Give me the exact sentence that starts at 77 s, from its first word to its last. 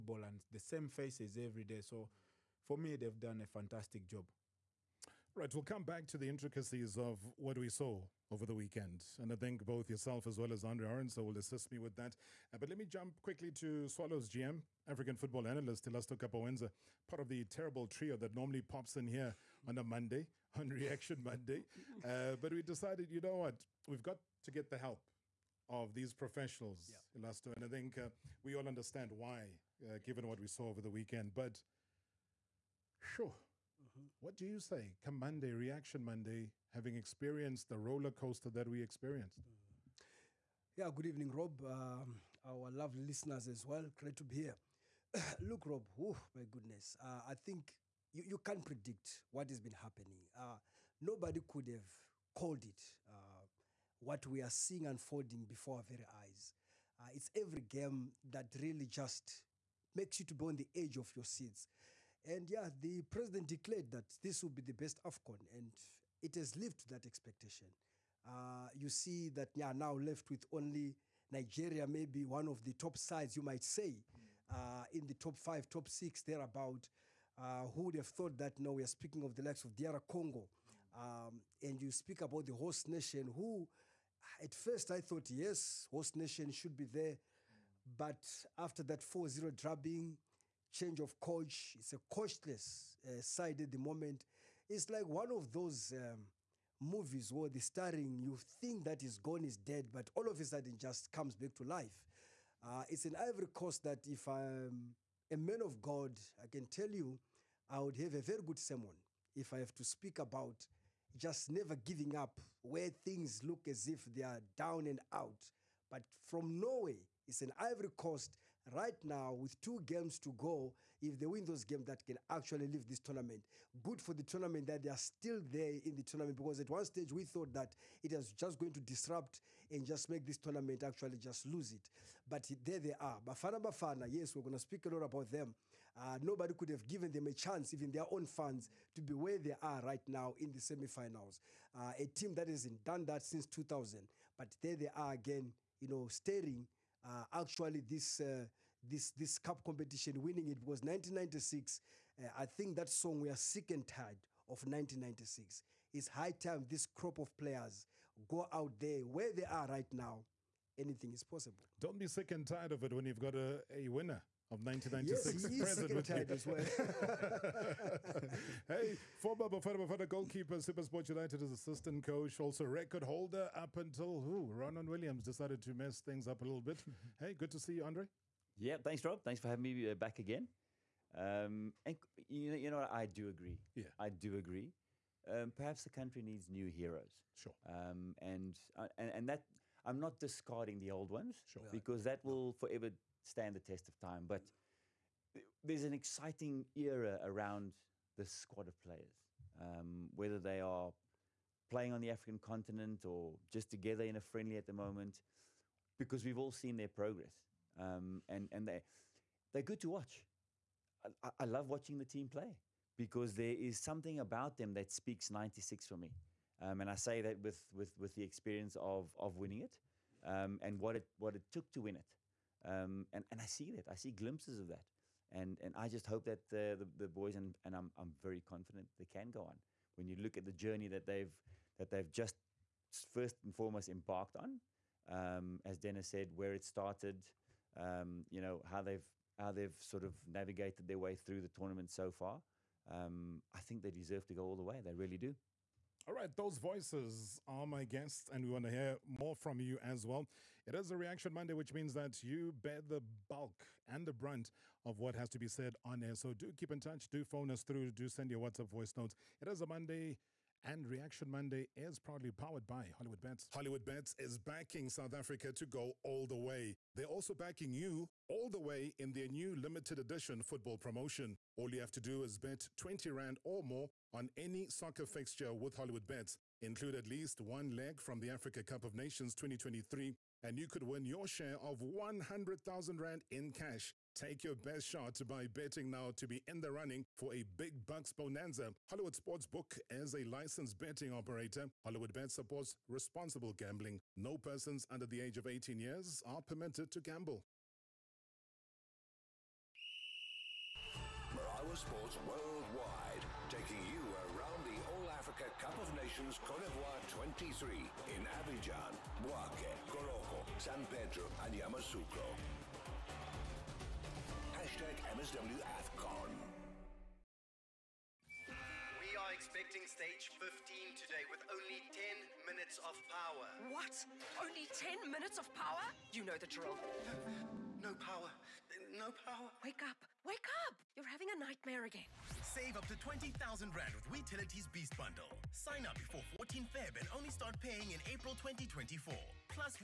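Uh, who would have thought that now we are speaking of the likes of DR Congo?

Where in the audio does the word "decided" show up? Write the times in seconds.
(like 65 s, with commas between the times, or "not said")
22 s, 175 s.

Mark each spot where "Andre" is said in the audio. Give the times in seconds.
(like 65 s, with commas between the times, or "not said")
10 s, 177 s.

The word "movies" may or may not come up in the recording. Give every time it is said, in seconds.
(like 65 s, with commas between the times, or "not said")
96 s.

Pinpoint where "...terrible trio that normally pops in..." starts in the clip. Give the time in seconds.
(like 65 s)
17 s.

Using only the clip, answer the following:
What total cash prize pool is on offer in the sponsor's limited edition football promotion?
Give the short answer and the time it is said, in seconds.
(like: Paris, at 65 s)
100,000 Rand, at 281 s.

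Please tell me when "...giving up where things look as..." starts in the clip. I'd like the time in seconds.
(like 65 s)
111 s.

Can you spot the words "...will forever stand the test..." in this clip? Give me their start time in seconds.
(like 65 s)
192 s.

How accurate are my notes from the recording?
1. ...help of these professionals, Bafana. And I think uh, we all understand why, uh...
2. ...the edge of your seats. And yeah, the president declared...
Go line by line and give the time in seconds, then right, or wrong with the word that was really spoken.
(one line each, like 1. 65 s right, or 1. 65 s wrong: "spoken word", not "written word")
1. 24 s wrong: "Elasto", not "Bafana"
2. 60 s right.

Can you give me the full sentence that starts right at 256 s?
So do keep in touch, do phone us through, do send your WhatsApp voice notes.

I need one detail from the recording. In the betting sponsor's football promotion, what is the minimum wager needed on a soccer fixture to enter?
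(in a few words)
20 Rand.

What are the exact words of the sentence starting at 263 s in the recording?
Hollywood Bets is backing South Africa to go all the way.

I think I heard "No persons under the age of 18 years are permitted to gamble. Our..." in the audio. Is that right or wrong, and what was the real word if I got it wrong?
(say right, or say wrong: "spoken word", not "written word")
right.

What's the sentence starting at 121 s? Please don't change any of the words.
If they win those games, that can actually leave this tournament.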